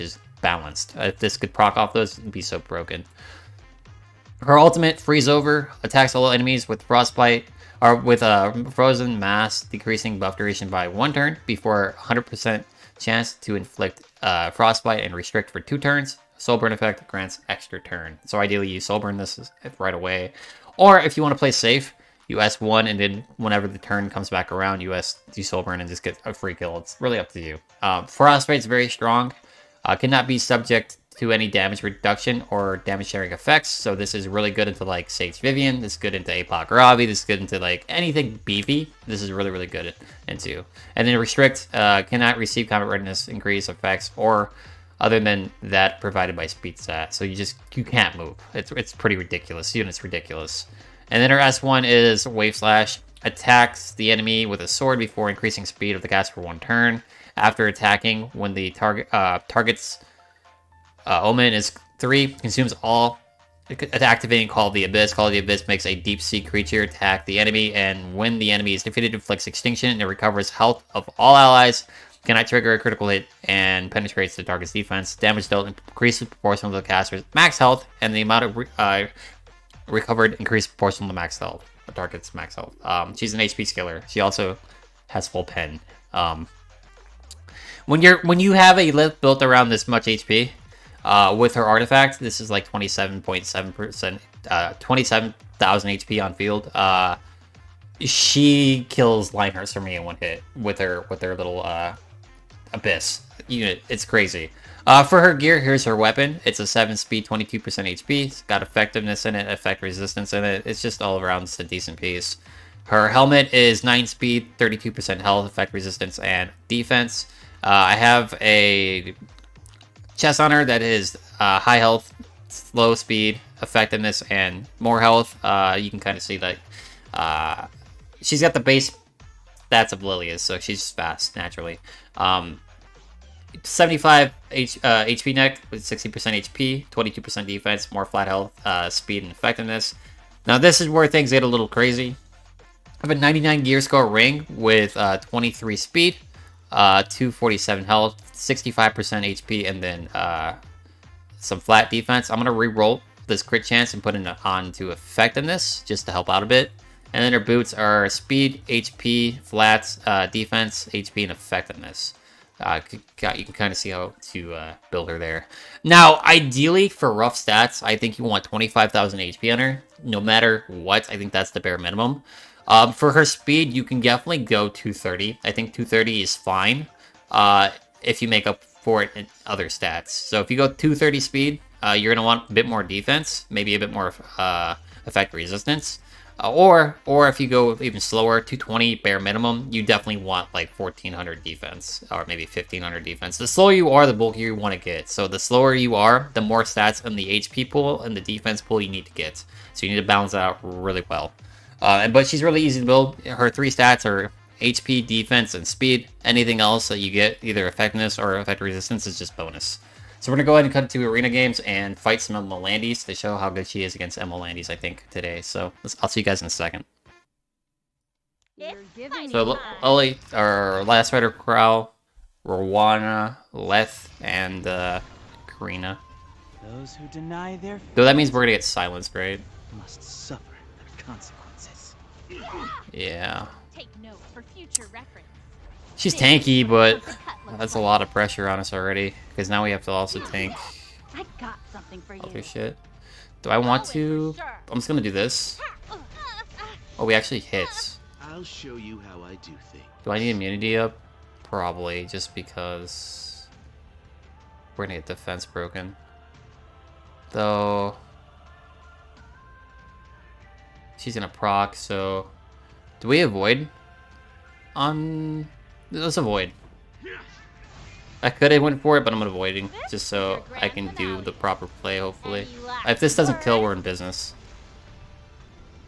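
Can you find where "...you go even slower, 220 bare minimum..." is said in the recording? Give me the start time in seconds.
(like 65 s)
187 s.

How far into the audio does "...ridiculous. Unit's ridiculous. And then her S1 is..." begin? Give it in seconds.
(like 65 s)
49 s.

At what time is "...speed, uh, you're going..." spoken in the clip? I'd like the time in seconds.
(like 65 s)
181 s.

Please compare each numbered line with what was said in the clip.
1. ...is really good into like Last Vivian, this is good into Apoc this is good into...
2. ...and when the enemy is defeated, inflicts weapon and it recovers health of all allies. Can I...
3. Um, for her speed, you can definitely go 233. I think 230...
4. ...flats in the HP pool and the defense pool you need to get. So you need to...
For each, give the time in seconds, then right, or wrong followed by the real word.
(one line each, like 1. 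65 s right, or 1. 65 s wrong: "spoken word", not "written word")
1. 34 s wrong: "Sage", not "Last"
2. 67 s wrong: "extinction", not "weapon"
3. 172 s wrong: "230", not "233"
4. 196 s wrong: "stats", not "flats".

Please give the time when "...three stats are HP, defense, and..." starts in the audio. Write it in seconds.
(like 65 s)
203 s.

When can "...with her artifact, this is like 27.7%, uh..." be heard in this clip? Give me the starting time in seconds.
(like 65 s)
91 s.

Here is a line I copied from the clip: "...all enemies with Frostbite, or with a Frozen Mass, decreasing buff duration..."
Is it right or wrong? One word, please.
right.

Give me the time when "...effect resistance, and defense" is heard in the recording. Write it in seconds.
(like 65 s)
115 s.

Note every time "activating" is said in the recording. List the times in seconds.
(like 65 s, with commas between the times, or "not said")
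63 s.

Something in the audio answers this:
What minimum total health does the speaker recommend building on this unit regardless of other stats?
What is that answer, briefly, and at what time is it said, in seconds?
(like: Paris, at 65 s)
25,000, at 168 s.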